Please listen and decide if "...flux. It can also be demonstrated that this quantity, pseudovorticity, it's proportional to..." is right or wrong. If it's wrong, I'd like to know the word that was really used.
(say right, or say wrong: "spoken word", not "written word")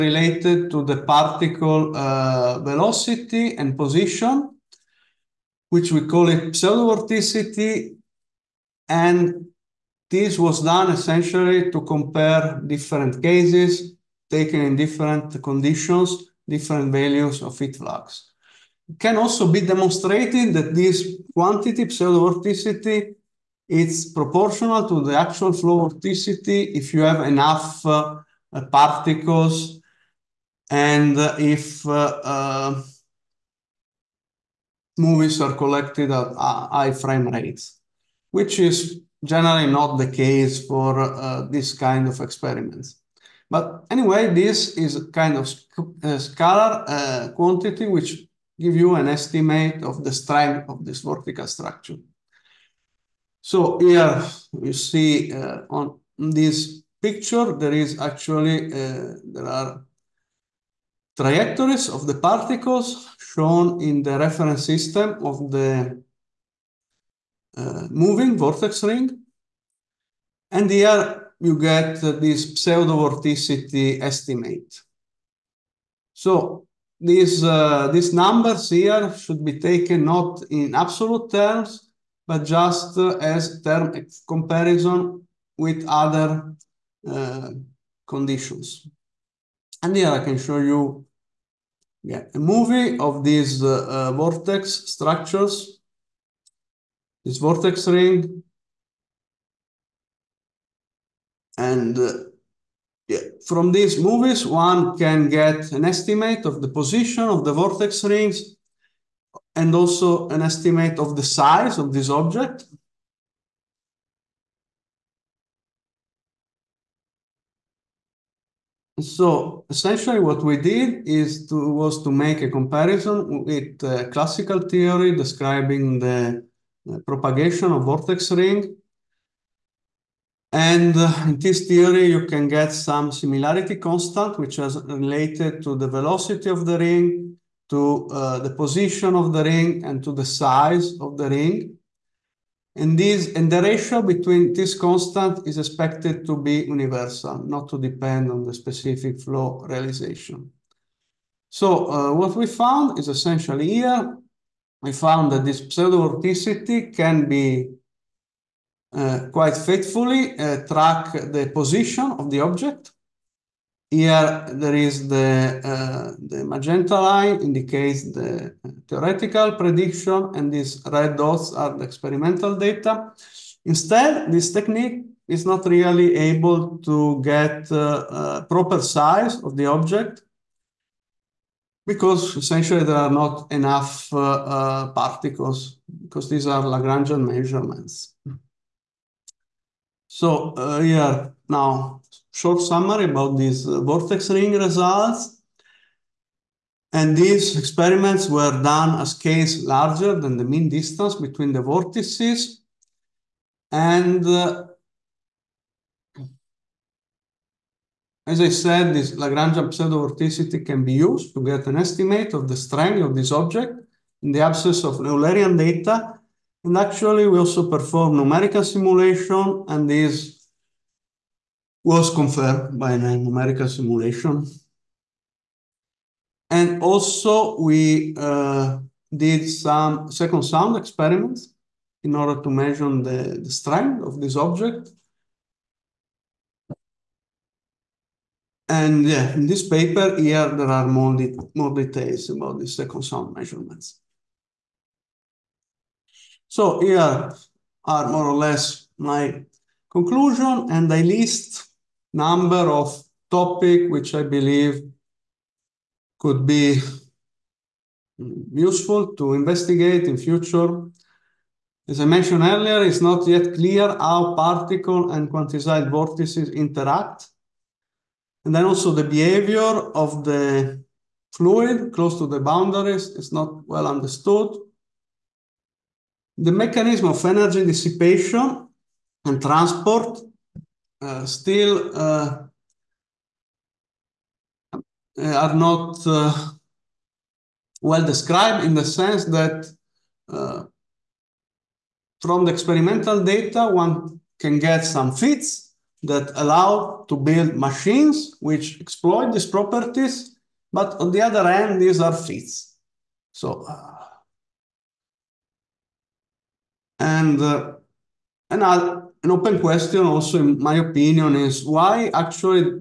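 right.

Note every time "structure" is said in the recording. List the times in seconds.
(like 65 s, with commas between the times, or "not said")
51 s, 94 s.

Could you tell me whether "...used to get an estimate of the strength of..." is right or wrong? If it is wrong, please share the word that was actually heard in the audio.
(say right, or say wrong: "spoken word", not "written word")
right.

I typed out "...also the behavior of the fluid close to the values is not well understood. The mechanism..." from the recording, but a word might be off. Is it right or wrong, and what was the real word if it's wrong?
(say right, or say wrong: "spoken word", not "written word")
wrong: "boundaries", not "values".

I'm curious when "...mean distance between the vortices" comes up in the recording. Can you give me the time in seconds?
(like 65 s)
200 s.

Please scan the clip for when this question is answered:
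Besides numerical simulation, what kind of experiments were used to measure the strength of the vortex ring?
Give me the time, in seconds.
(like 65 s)
230 s.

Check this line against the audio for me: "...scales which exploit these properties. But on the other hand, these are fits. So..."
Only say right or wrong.
wrong.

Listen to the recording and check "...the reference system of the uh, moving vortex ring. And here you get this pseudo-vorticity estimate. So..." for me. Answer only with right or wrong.
right.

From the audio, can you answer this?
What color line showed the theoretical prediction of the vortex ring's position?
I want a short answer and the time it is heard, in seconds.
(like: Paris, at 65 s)
magenta, at 166 s.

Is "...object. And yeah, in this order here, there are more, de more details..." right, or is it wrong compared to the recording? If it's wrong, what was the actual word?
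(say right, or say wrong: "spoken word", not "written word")
wrong: "paper", not "order".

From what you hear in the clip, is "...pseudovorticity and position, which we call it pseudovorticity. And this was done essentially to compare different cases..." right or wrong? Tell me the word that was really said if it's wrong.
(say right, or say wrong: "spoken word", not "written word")
wrong: "velocity", not "pseudovorticity".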